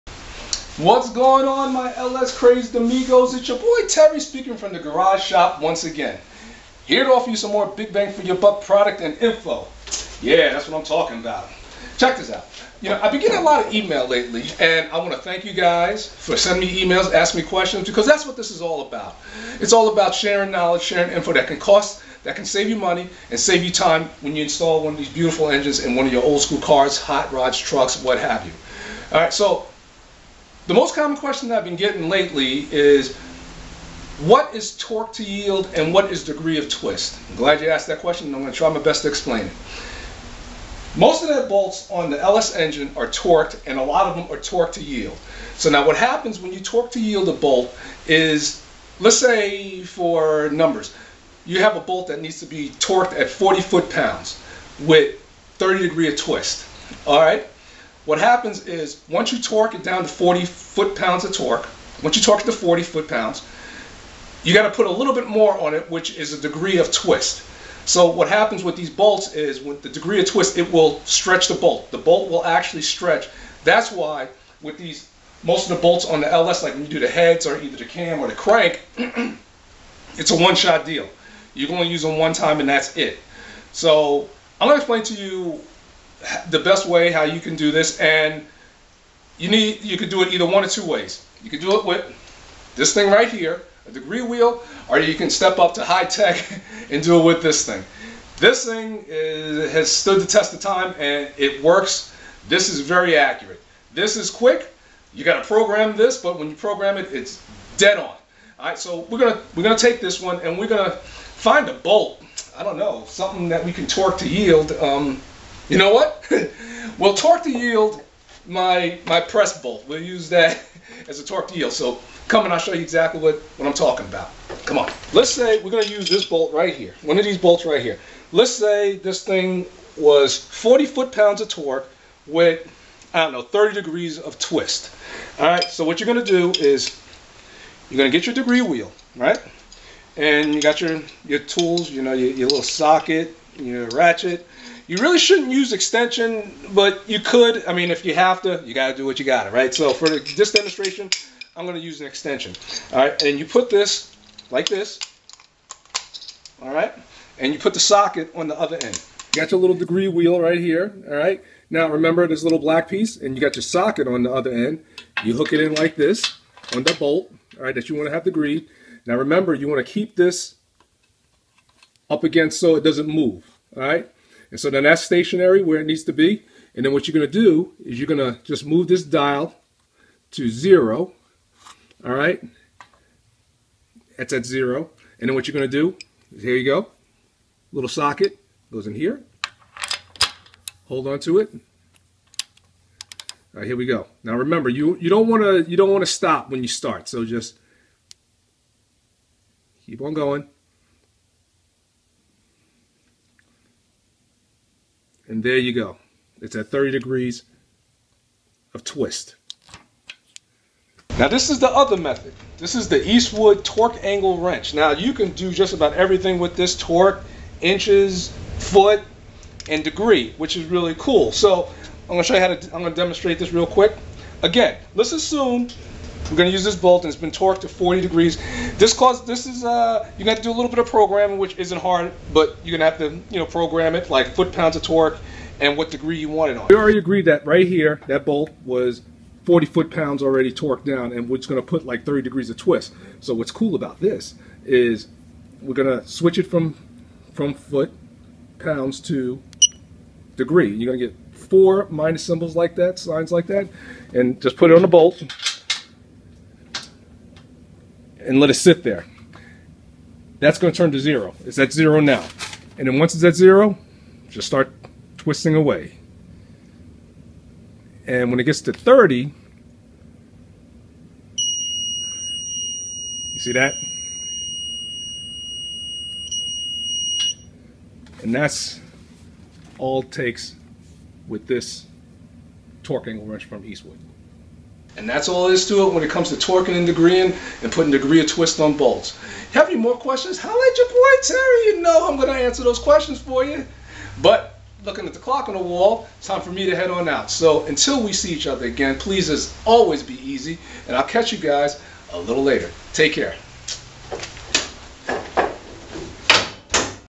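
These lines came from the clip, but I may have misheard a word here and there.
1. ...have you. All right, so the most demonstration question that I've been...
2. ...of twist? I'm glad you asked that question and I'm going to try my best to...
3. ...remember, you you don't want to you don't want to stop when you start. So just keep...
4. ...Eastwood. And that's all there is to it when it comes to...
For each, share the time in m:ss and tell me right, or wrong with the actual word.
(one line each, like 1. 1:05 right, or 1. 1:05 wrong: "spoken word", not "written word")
1. 0:28 wrong: "common", not "demonstration"
2. 0:36 right
3. 3:14 right
4. 4:43 right.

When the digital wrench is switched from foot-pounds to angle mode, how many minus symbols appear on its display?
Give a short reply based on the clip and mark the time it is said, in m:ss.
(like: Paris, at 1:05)
4, at 4:11.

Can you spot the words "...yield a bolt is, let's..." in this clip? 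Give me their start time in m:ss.
0:46.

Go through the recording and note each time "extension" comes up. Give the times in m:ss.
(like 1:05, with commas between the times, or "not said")
2:25, 2:32.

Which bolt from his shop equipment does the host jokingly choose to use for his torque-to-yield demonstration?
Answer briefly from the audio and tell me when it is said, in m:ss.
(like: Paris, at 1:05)
press bolt, at 1:59.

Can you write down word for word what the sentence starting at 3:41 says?
So I'm gonna show you how to, I'm gonna demonstrate this real quick.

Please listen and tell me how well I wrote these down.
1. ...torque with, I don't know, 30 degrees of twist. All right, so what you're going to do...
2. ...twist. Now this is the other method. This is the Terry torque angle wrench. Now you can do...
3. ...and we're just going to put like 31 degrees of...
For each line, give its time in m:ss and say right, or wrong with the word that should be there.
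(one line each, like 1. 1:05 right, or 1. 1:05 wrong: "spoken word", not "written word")
1. 2:11 right
2. 3:28 wrong: "Eastwood", not "Terry"
3. 4:01 wrong: "30", not "31".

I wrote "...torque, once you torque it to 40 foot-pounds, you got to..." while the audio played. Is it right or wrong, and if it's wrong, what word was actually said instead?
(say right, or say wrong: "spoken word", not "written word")
right.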